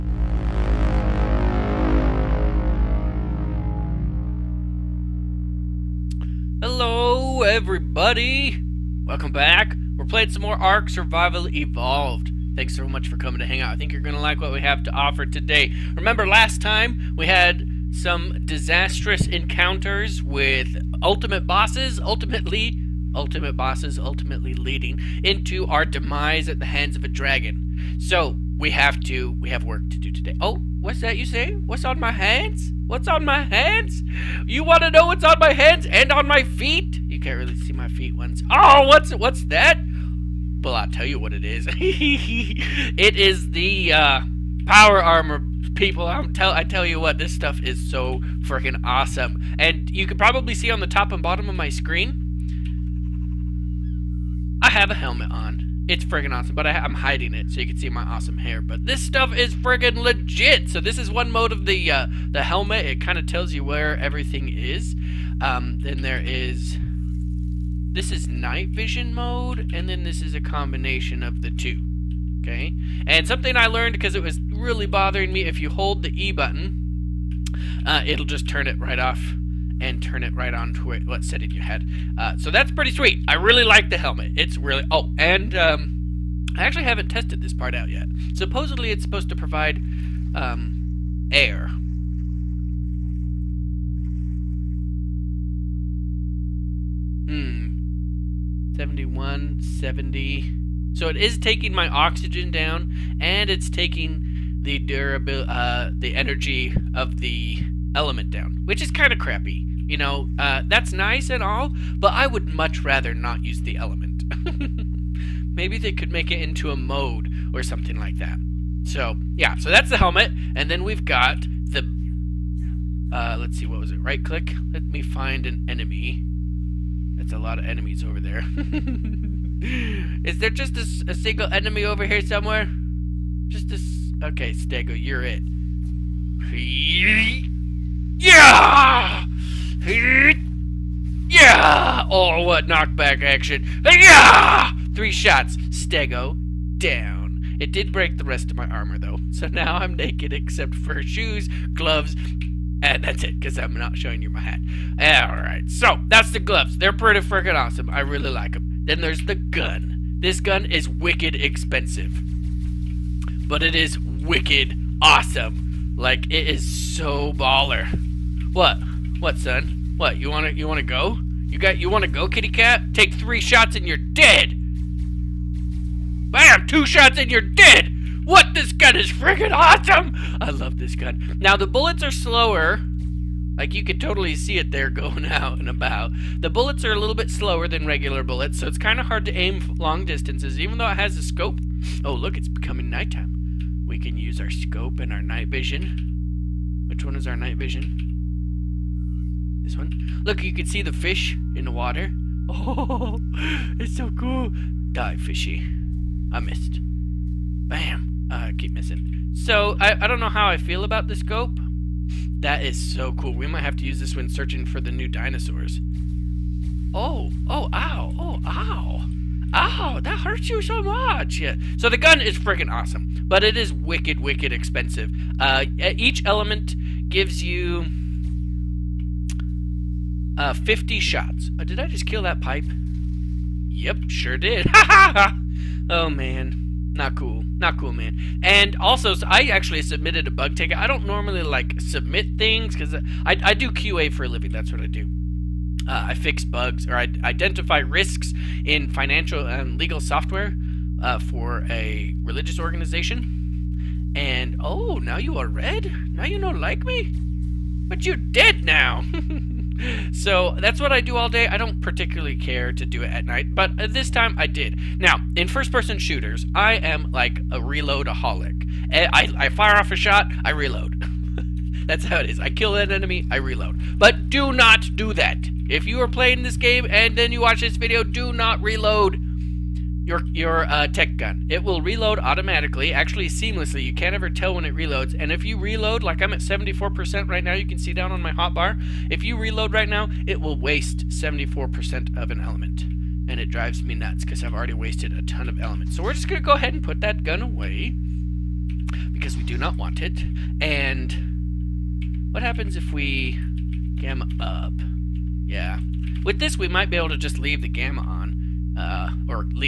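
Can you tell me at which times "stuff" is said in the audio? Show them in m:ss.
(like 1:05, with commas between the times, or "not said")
0:47, 0:59.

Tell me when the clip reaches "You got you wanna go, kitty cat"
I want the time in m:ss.
2:51.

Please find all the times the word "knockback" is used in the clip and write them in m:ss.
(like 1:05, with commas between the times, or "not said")
2:22.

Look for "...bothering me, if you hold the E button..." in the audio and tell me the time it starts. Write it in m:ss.
1:14.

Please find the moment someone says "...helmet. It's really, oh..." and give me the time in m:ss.
1:23.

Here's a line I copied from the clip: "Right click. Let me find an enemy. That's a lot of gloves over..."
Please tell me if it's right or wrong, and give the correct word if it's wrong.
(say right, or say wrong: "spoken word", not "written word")
wrong: "enemies", not "gloves".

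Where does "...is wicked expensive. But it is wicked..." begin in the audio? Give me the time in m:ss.
2:40.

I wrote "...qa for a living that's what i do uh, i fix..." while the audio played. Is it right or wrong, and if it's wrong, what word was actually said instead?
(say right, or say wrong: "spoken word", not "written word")
right.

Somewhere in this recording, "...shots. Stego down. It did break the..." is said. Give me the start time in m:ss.
2:25.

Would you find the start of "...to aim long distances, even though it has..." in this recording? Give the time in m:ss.
3:09.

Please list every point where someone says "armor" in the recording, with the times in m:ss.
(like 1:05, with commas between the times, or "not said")
0:45, 2:28.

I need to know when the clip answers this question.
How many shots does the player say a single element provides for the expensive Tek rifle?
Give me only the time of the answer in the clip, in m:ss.
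3:50.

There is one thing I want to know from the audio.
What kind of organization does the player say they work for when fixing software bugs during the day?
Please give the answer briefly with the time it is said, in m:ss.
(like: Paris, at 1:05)
religious organization, at 4:12.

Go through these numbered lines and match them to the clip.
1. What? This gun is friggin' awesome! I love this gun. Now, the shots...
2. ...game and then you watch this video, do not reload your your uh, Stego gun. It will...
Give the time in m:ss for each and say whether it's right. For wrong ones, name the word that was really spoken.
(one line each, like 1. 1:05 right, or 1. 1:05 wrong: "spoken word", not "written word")
1. 2:58 wrong: "bullets", not "shots"
2. 4:36 wrong: "Tek", not "Stego".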